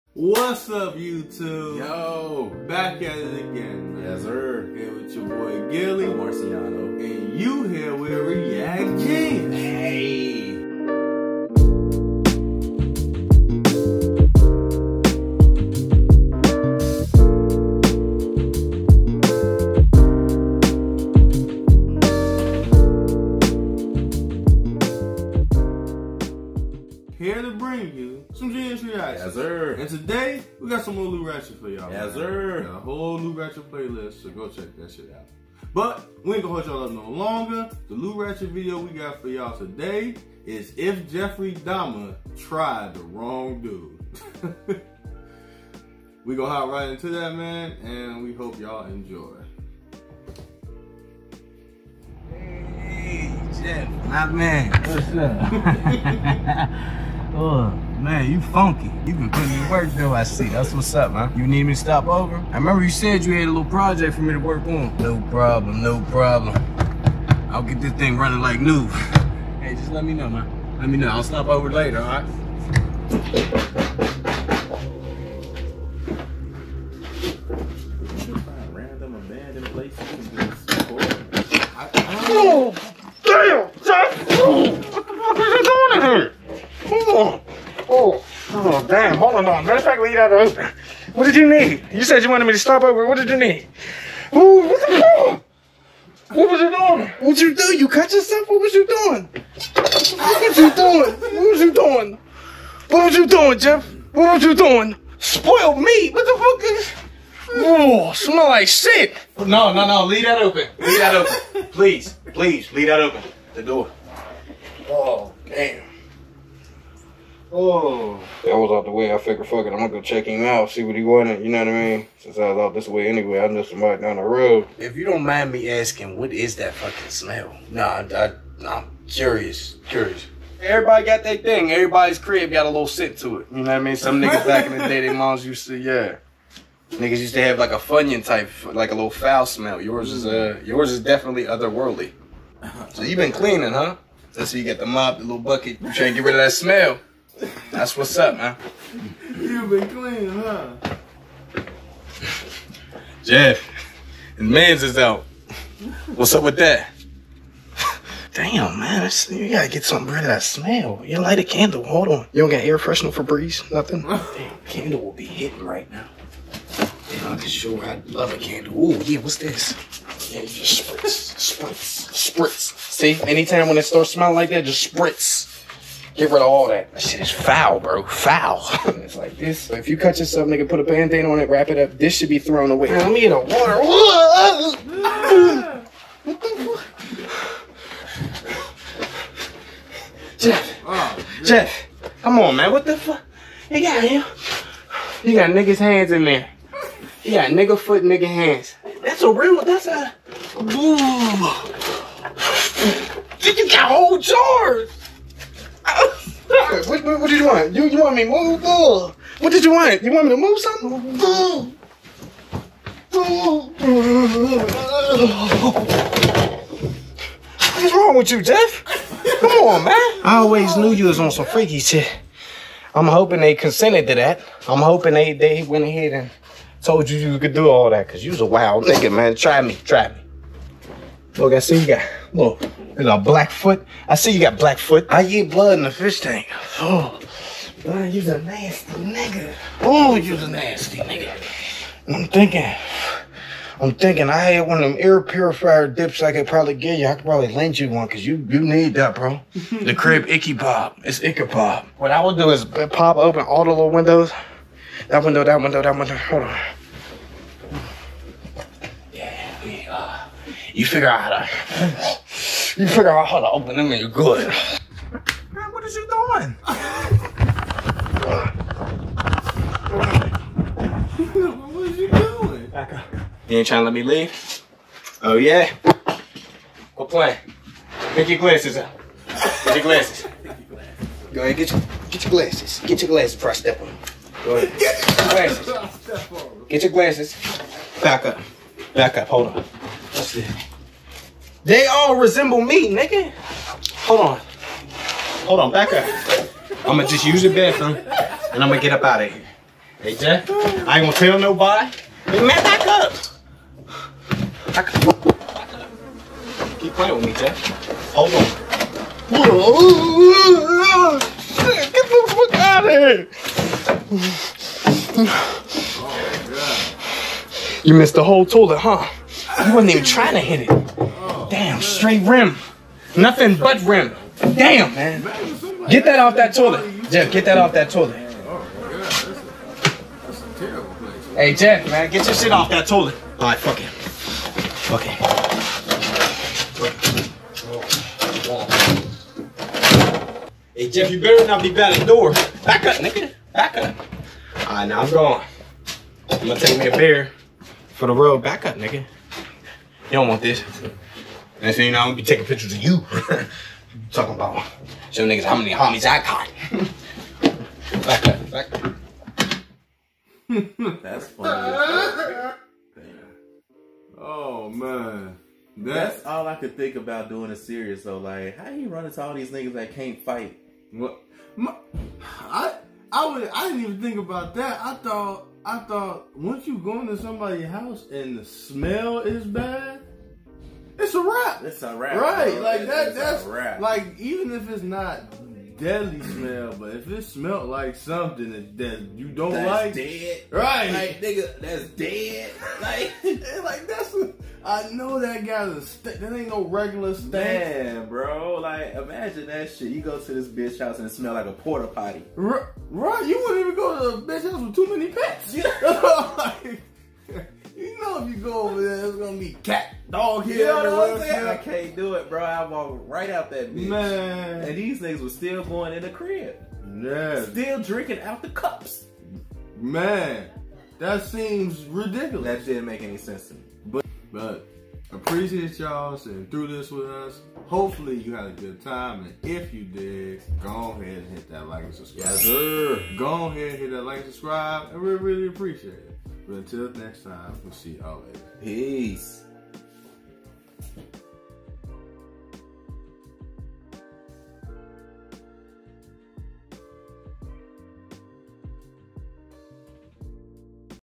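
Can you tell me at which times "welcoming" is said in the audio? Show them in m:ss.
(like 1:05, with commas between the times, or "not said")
not said.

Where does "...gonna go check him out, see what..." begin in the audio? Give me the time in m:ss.
1:59.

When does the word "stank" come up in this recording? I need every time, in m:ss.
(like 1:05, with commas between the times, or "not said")
6:37.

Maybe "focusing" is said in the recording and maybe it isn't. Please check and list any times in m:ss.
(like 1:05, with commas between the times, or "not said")
not said.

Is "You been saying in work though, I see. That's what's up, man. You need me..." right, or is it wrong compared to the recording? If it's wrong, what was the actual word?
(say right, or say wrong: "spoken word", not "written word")
wrong: "putting", not "saying".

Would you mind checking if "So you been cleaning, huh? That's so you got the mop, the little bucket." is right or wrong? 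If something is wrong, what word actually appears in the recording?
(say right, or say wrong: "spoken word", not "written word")
right.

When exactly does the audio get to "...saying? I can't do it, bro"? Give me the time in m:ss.
6:51.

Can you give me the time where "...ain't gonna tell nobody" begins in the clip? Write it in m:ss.
5:00.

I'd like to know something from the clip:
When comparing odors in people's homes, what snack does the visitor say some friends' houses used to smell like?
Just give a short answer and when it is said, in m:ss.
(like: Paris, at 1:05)
Funyun, at 2:17.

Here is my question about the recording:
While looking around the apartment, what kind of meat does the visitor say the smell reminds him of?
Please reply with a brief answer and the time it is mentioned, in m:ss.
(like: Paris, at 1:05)
Spoiled meat, at 1:45.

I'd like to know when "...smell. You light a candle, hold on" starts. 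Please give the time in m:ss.
2:40.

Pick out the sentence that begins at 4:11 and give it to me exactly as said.
What I would do is pop open all the little windows.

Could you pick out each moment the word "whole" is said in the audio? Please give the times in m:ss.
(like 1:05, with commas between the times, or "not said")
0:32, 3:23, 5:18.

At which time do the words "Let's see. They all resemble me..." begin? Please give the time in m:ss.
4:50.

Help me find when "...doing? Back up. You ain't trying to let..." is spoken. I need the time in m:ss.
4:32.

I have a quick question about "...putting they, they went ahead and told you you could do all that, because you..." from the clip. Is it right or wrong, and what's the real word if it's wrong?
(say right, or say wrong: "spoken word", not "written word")
wrong: "hoping", not "putting".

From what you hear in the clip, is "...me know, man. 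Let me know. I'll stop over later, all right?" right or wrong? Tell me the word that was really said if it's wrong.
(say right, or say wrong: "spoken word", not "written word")
right.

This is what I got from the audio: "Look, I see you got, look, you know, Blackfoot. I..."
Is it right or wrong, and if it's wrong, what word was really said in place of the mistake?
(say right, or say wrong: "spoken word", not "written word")
right.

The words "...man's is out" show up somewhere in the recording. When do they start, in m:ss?
2:34.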